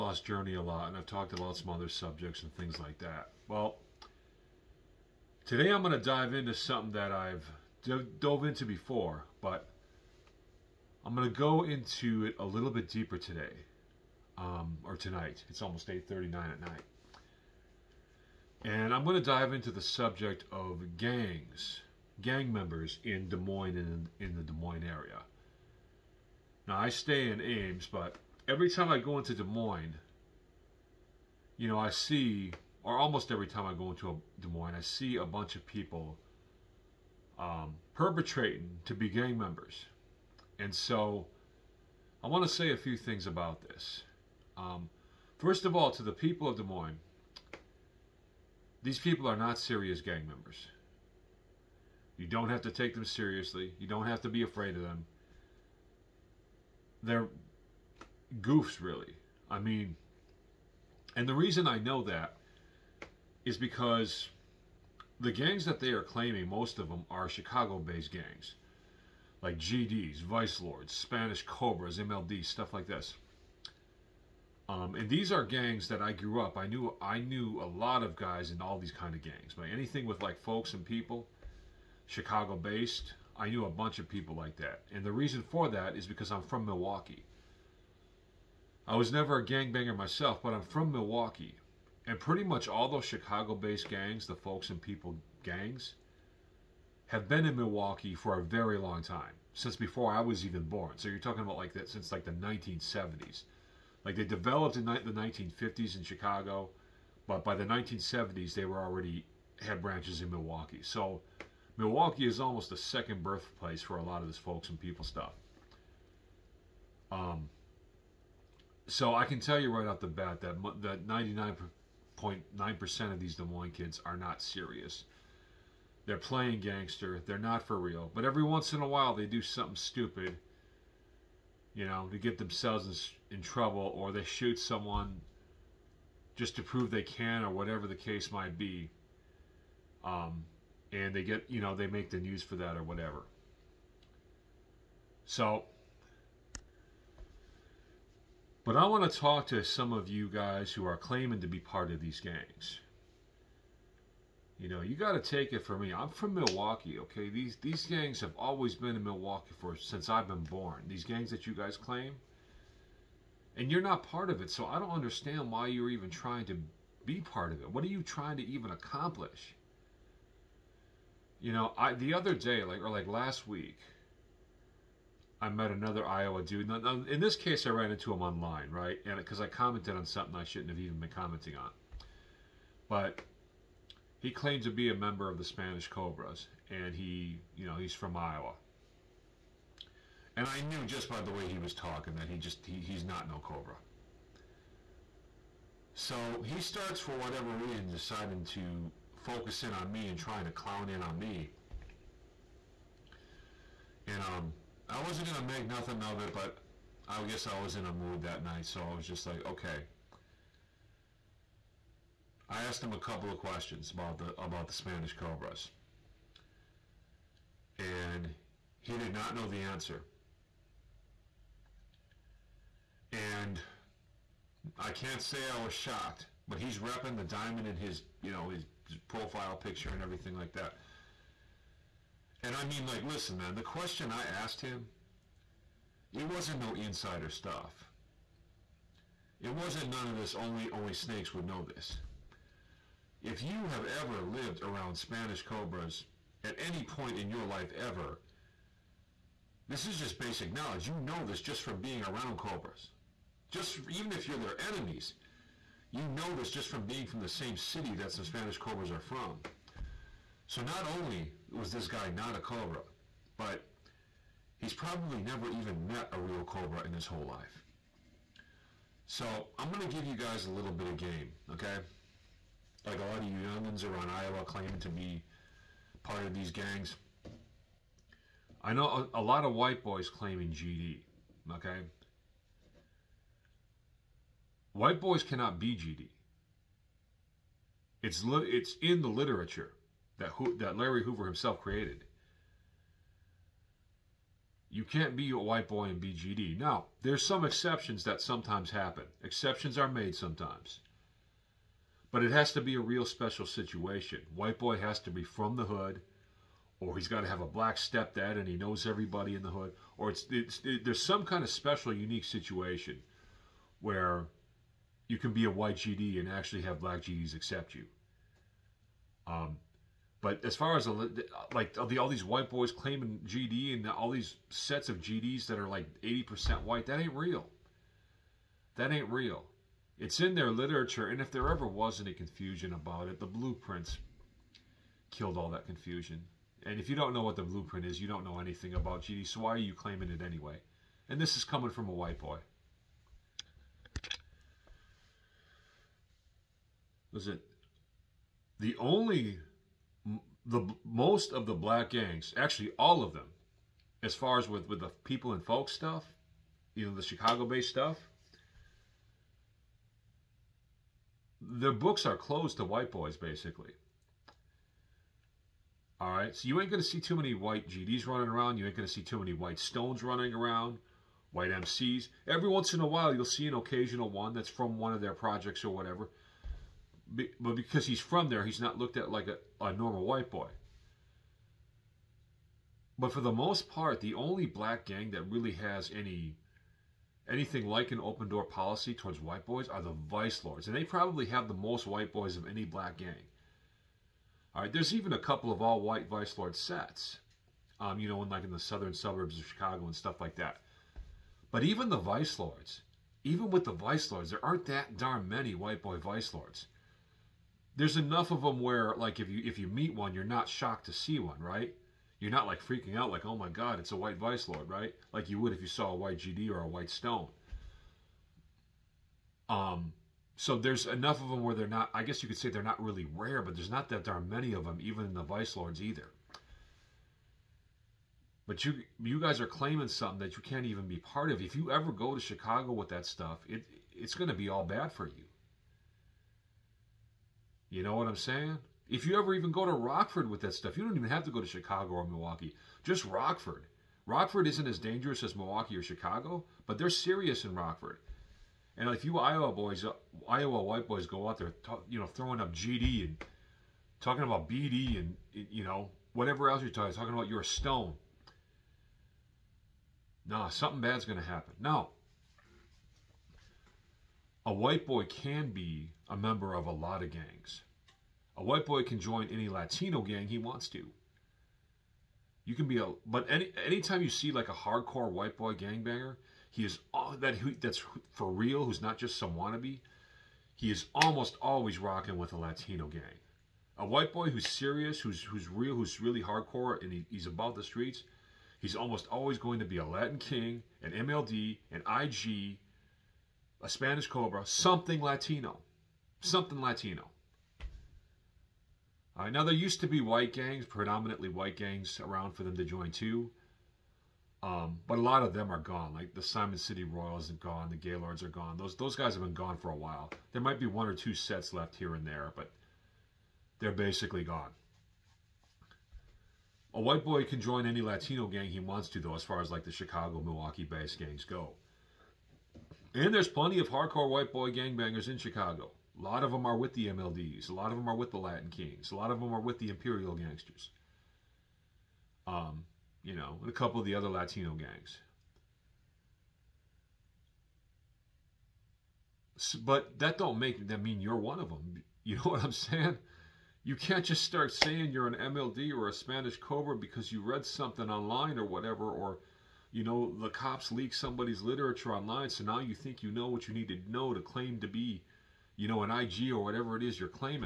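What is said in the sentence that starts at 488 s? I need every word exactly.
He's almost always going to be a Latin King, an MLD, an IG, a Spanish Cobra, something Latino, something Latino.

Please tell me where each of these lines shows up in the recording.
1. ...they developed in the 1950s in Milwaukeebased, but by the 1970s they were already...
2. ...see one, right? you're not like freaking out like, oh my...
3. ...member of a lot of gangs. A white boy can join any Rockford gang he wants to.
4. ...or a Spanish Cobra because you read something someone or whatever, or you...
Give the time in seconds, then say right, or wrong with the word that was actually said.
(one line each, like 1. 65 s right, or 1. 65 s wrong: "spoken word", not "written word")
1. 104 s wrong: "Chicago", not "Milwaukeebased"
2. 410 s right
3. 466 s wrong: "Latino", not "Rockford"
4. 545 s wrong: "online", not "someone".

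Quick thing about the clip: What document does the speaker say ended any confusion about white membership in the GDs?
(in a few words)
the blueprints.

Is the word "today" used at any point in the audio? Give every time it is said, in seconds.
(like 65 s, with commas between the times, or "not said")
5 s, 13 s.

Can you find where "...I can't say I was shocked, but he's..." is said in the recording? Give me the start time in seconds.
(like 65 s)
224 s.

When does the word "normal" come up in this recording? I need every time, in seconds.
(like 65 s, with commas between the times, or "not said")
379 s.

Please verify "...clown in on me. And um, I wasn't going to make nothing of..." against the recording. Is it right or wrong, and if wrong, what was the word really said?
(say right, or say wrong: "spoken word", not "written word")
right.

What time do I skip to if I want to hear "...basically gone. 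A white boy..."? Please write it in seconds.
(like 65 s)
513 s.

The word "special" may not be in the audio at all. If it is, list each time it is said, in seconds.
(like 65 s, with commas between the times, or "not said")
303 s, 311 s.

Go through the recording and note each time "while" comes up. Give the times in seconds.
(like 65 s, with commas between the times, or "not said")
128 s, 372 s, 509 s.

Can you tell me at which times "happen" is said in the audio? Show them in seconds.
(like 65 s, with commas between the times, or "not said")
298 s, 461 s.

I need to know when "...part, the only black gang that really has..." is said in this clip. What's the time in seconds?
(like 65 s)
383 s.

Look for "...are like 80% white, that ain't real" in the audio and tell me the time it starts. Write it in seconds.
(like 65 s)
325 s.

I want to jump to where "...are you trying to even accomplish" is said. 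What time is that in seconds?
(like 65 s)
167 s.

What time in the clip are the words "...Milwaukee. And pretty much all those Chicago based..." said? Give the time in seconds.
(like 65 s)
90 s.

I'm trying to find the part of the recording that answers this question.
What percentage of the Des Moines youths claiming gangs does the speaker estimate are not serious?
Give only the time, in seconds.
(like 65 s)
121 s.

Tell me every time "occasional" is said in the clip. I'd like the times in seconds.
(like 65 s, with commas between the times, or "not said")
373 s.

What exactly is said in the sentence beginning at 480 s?
He is almost always rocking with a Latino gang.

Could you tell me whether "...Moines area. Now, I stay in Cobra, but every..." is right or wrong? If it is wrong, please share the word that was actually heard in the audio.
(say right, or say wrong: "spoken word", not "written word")
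wrong: "Ames", not "Cobra".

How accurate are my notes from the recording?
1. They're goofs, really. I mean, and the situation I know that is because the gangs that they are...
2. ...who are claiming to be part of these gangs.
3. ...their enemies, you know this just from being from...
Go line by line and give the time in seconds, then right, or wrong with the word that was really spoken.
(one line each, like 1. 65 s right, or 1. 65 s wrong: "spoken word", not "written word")
1. 57 s wrong: "reason", not "situation"
2. 150 s right
3. 254 s right.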